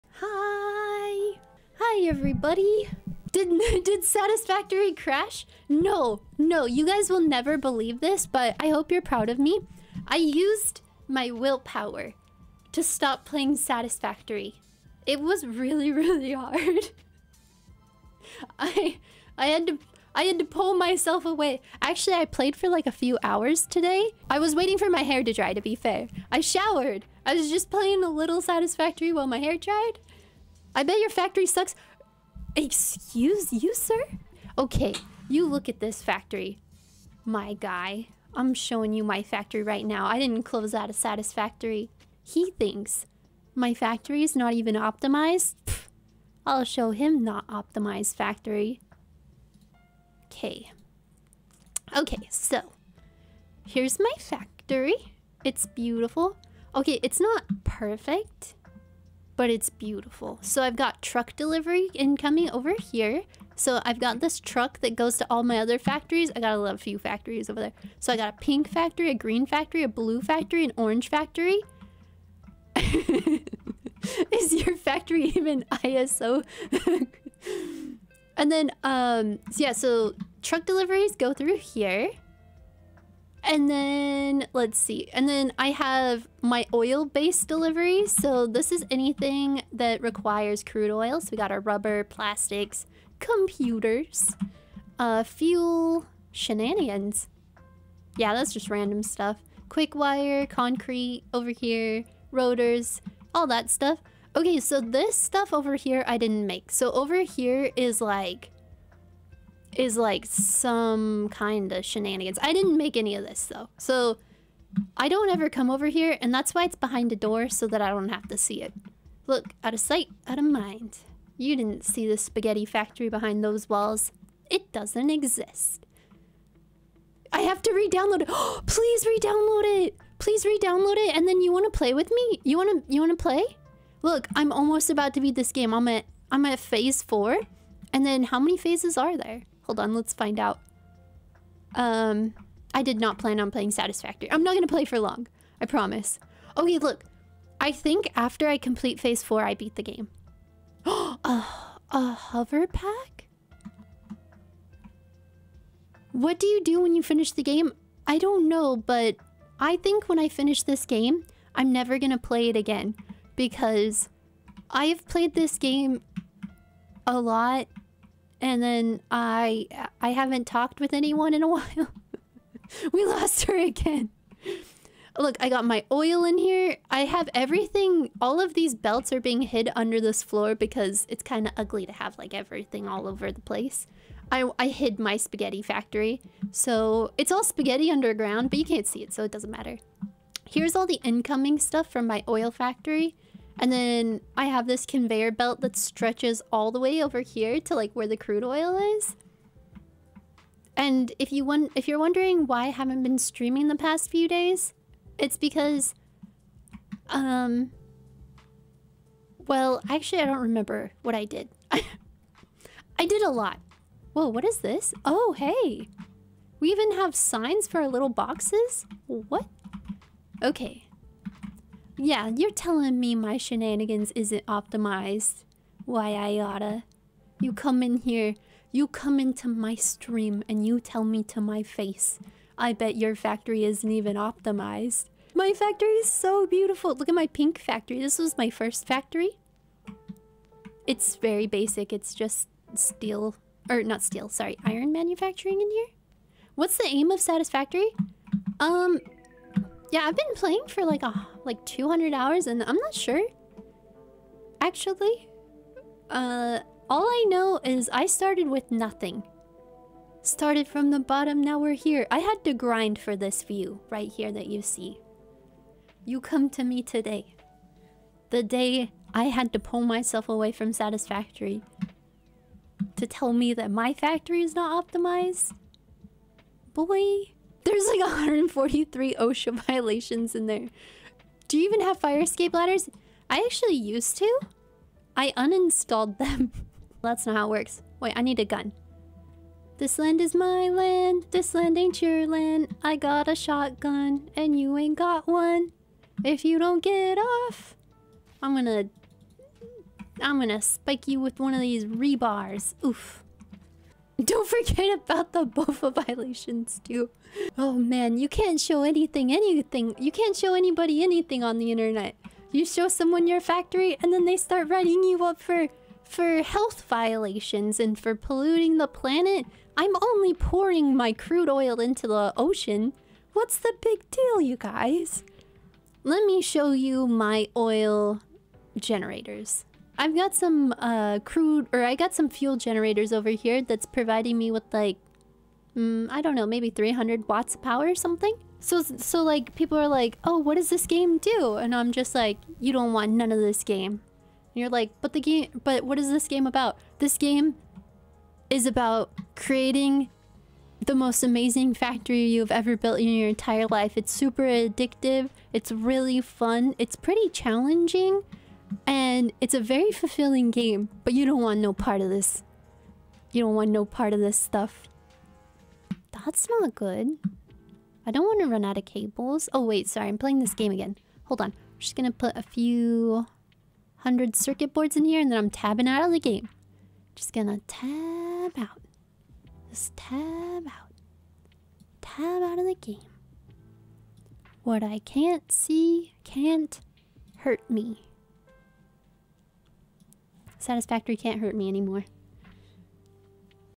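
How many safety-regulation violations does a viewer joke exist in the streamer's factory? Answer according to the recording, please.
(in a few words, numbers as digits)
143.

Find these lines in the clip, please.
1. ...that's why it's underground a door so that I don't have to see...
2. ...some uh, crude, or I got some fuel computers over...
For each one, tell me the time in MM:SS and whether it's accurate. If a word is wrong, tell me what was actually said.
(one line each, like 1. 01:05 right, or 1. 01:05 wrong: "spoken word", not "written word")
1. 01:56 wrong: "behind", not "underground"
2. 05:30 wrong: "generators", not "computers".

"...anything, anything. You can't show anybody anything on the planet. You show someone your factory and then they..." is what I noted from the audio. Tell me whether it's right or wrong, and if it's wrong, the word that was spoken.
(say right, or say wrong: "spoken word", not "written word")
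wrong: "internet", not "planet".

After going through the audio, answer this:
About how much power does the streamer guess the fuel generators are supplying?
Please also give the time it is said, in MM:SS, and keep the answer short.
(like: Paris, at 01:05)
300 watts, at 05:36.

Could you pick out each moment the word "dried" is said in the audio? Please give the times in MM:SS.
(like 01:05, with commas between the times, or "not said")
00:29.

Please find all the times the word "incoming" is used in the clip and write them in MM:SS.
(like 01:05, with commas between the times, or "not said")
01:01, 03:11.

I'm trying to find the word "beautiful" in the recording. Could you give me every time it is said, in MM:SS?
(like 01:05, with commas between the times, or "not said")
00:55, 00:59, 03:56.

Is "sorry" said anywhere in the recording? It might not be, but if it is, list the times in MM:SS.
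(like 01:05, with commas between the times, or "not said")
04:04, 06:09.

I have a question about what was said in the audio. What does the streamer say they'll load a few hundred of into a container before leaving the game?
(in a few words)
Circuit boards.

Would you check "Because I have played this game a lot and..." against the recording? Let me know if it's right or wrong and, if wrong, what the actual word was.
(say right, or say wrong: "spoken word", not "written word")
right.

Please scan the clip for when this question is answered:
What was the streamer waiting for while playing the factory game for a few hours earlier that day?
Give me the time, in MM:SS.
00:24.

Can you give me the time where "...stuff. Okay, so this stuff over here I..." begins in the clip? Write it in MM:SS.
01:43.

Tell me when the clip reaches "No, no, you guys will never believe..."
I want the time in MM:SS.
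00:05.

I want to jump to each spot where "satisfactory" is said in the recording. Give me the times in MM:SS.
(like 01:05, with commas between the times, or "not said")
00:04, 00:13, 00:28, 00:40, 02:23, 04:07, 04:30, 06:30.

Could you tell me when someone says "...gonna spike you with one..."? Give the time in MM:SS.
05:00.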